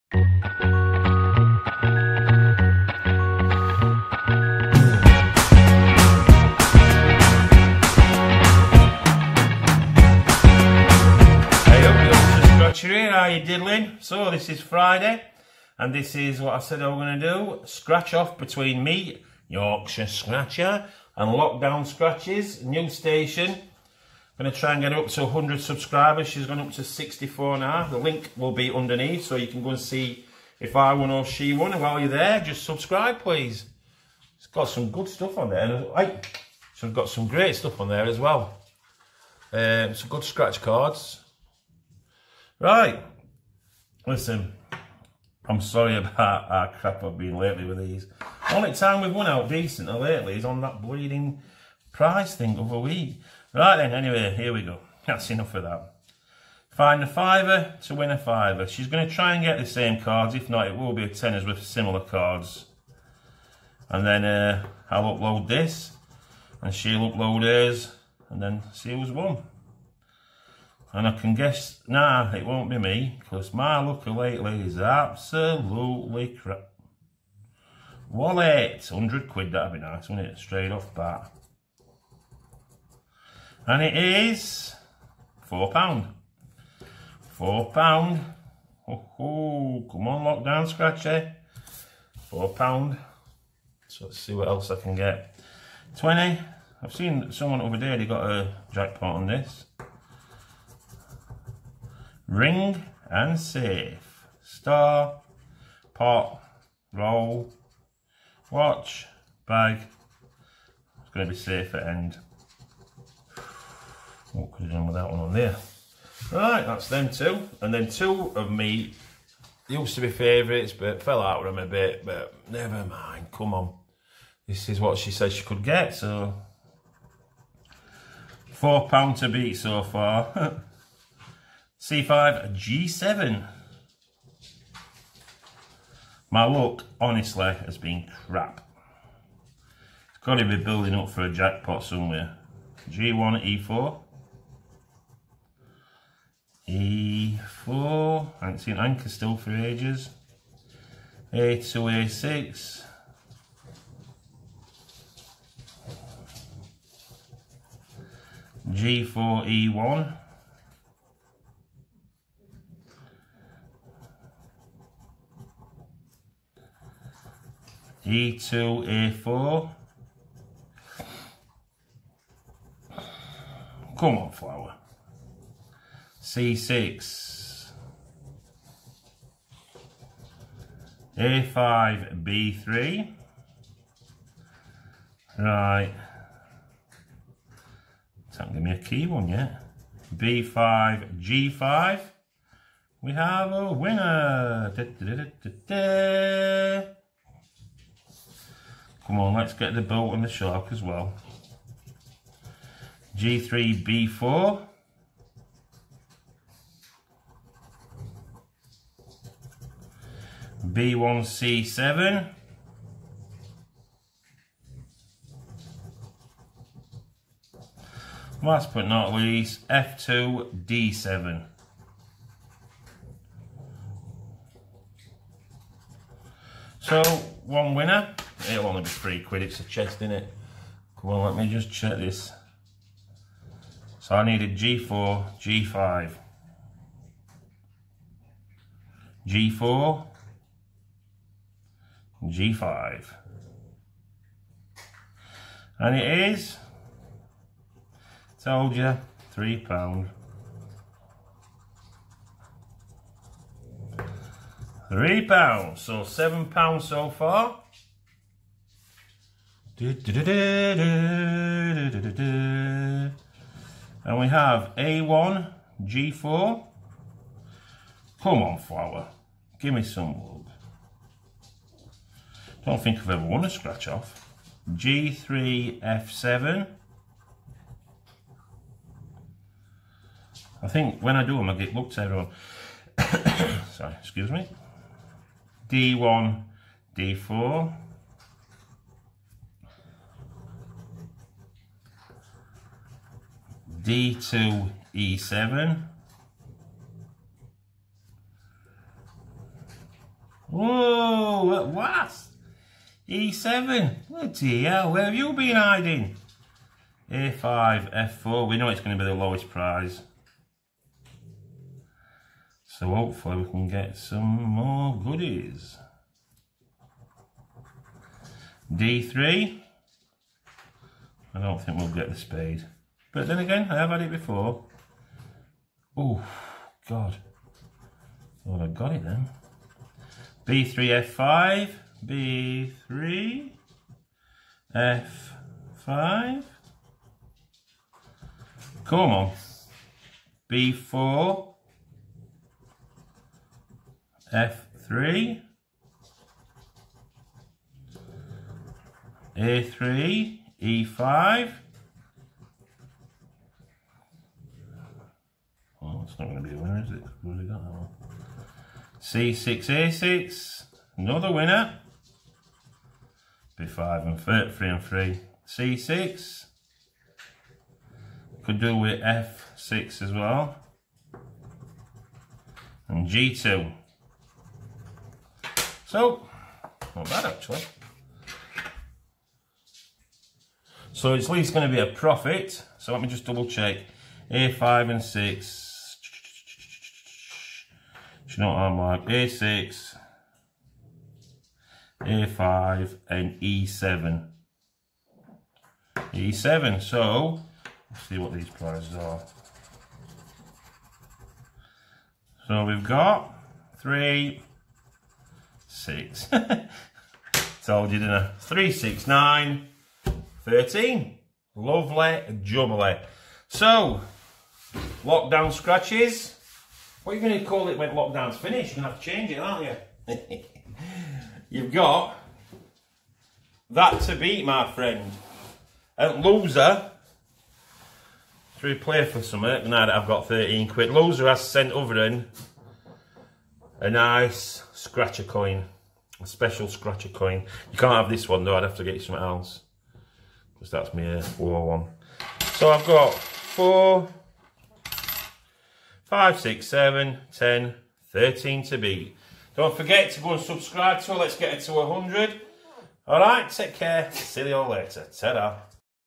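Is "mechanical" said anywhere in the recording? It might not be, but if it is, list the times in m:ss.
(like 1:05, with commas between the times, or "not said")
not said.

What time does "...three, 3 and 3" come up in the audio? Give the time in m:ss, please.
6:04.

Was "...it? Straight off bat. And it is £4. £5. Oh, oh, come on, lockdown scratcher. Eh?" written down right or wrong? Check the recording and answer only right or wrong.
wrong.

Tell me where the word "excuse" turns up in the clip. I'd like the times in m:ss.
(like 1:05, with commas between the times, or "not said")
4:44.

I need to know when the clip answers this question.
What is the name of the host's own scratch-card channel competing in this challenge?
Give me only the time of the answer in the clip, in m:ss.
0:19.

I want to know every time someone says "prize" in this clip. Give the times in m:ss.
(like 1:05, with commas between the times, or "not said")
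0:51, 5:09, 6:38.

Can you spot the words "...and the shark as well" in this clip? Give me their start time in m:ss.
3:20.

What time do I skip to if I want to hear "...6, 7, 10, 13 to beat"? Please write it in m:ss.
7:26.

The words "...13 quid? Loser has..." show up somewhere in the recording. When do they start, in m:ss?
7:10.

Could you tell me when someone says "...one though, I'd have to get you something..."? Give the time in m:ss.
7:18.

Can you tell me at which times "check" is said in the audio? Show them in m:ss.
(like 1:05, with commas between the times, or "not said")
3:51, 6:23.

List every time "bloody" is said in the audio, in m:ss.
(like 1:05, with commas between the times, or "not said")
5:04.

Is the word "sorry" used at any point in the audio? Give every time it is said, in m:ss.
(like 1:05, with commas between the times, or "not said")
0:45, 4:43.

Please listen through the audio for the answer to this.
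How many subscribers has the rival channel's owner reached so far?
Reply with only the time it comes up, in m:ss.
0:26.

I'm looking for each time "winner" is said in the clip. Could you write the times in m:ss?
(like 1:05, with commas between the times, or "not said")
3:13, 3:47, 6:01.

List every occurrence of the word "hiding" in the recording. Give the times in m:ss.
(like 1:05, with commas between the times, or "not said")
5:05.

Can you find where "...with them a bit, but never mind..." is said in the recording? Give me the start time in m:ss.
2:01.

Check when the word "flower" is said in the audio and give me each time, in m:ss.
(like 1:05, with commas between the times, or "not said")
2:54, 4:28.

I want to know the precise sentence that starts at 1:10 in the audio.
And I can guess now nah, it won't be me because my looker lately is absolutely crap.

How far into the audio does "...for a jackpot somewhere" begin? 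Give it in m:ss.
2:21.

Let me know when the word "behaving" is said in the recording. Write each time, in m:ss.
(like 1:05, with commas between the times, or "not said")
not said.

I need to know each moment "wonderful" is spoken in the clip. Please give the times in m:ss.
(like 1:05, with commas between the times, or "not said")
not said.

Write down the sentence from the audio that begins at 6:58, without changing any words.
You're going to have to change it, aren't you?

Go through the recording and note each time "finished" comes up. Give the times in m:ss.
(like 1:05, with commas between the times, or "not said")
6:58.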